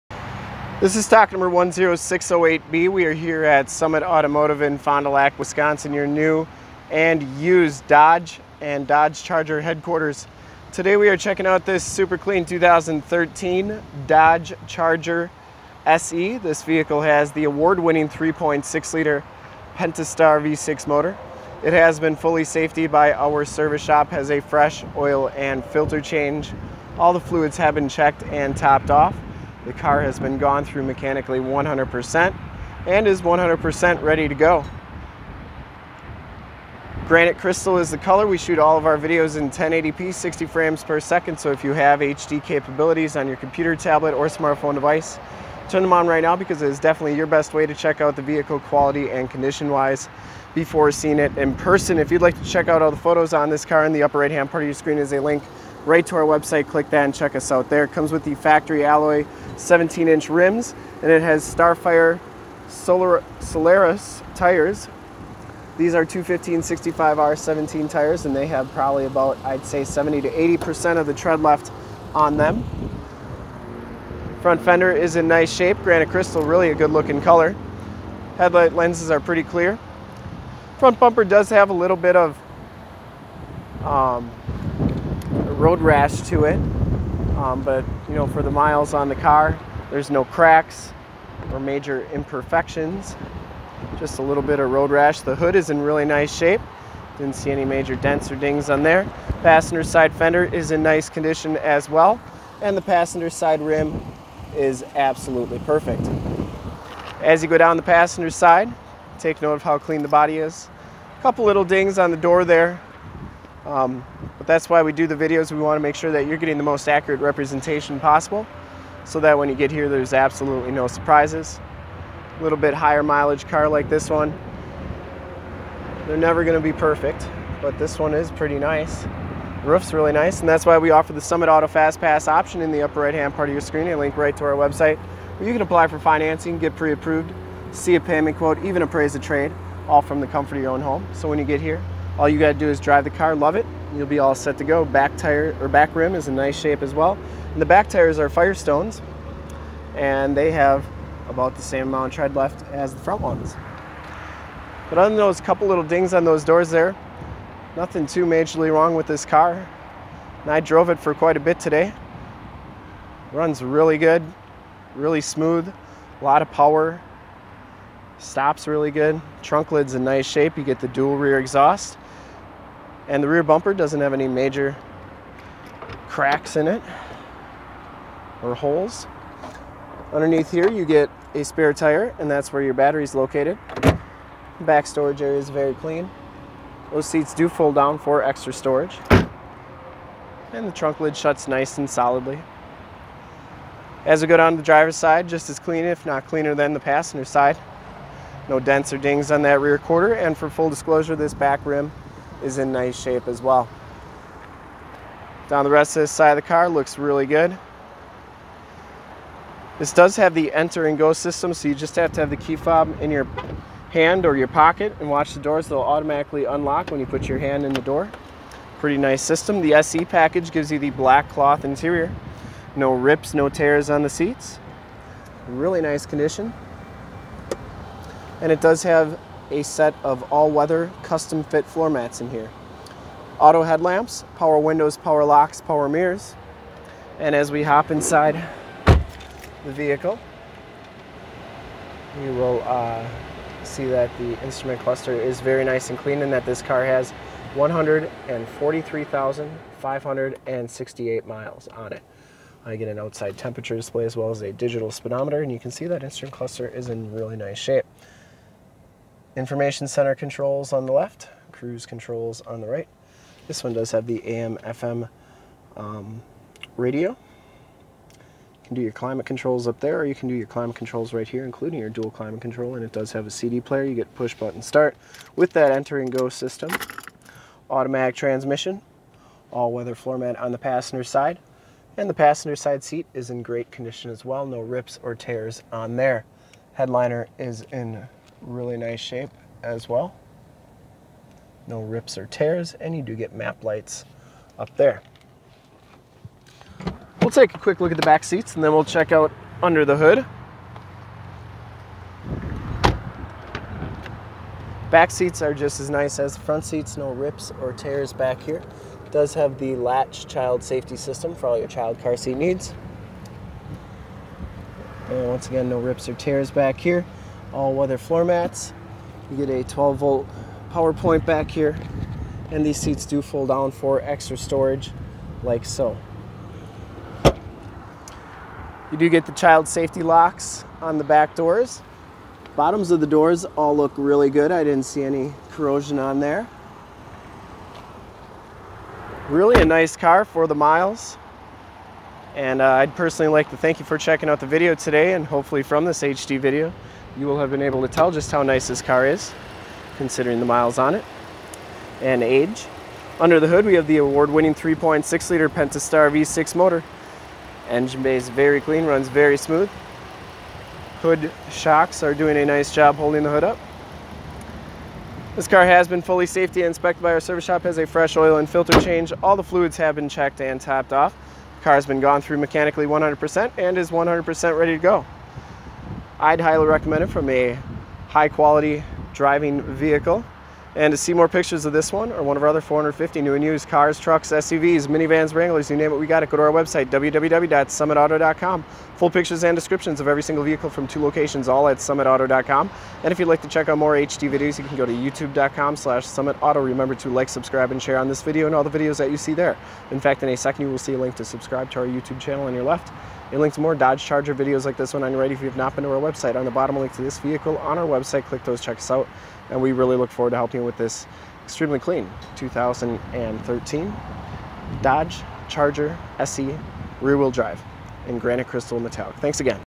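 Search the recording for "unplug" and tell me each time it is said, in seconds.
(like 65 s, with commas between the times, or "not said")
not said.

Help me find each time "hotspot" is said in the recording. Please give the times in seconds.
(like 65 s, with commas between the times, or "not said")
not said.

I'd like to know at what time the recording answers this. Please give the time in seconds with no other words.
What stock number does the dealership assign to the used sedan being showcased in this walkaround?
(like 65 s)
1 s.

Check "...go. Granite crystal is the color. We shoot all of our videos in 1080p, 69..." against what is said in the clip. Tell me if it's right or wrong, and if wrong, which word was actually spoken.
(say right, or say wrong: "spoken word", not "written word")
wrong: "60", not "69".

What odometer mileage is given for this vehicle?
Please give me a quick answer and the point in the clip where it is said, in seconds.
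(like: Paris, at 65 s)
143,568 miles, at 247 s.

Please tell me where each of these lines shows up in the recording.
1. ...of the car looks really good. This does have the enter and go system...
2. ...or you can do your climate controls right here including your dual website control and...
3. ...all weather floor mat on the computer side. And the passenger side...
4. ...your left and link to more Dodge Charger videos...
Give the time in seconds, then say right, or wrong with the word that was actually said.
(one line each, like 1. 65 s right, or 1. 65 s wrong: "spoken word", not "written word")
1. 206 s right
2. 269 s wrong: "climate", not "website"
3. 279 s wrong: "passenger", not "computer"
4. 402 s right.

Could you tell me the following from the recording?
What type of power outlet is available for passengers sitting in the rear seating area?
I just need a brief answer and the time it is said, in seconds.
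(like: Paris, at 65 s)
12-volt power point, at 319 s.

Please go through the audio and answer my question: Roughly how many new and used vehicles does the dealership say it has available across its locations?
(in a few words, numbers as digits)
450.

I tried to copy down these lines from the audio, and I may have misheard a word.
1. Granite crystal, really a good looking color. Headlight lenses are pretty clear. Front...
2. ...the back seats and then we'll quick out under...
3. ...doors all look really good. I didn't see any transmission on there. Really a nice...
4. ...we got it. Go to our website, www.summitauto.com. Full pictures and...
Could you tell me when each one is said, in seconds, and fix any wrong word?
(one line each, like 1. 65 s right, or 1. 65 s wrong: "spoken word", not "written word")
1. 75 s right
2. 297 s wrong: "check", not "quick"
3. 333 s wrong: "corrosion", not "transmission"
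4. 385 s right.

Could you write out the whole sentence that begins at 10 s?
Today we are checking out this super clean 2013 Dodge Charger SE.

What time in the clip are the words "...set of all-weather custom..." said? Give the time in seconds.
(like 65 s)
229 s.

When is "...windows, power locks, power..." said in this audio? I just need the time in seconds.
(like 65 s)
234 s.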